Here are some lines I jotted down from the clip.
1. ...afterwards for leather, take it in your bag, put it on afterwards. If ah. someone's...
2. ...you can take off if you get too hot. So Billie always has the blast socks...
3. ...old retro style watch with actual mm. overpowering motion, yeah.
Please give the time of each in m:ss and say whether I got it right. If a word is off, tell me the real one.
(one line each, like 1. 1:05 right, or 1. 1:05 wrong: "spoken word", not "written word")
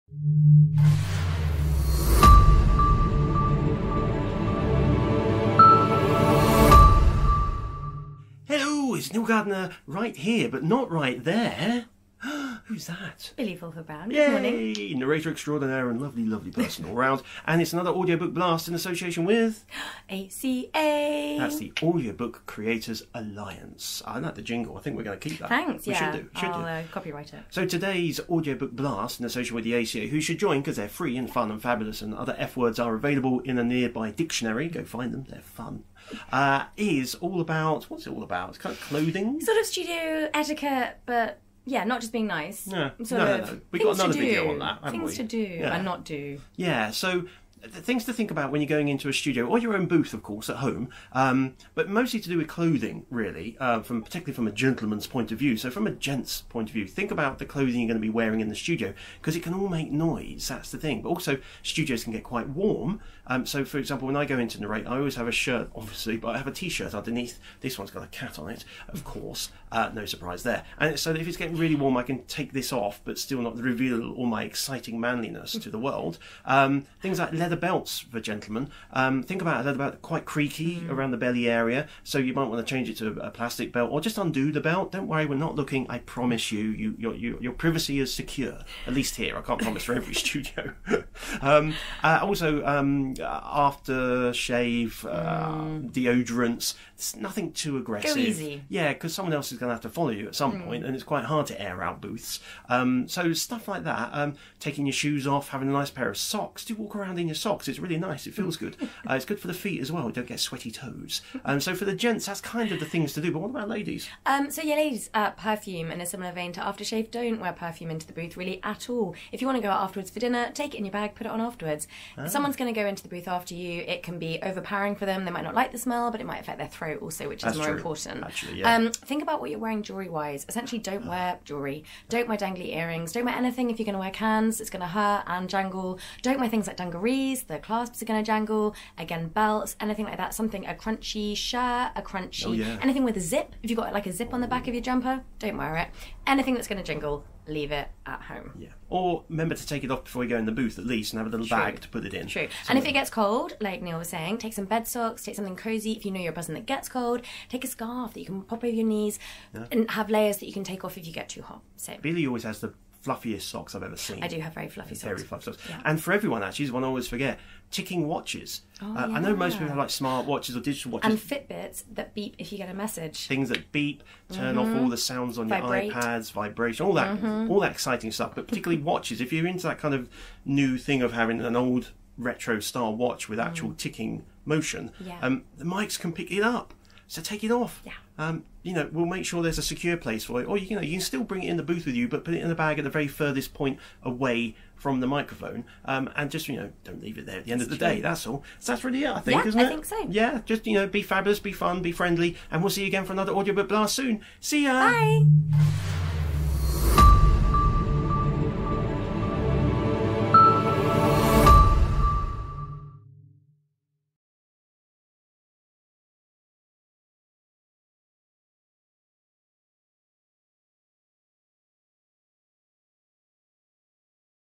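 1. 1:59 wrong: "dinner", not "leather"
2. 2:40 wrong: "fluffiest", not "blast"
3. 3:01 wrong: "ticking", not "overpowering".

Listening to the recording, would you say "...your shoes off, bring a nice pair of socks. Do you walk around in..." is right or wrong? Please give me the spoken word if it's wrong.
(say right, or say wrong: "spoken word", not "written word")
wrong: "having", not "bring".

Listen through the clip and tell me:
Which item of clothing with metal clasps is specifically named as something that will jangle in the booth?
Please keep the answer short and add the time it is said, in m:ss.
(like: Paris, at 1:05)
Dungarees, at 2:16.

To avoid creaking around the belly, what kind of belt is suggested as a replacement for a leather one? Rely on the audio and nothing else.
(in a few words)
Plastic belt.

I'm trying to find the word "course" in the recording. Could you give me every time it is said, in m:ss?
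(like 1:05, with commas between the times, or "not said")
0:50, 1:09.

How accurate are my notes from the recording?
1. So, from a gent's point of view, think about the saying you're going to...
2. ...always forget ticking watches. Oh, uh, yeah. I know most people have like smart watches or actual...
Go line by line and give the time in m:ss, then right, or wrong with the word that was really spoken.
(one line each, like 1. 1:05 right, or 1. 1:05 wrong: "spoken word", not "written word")
1. 0:55 wrong: "clothing", not "saying"
2. 2:46 wrong: "digital", not "actual".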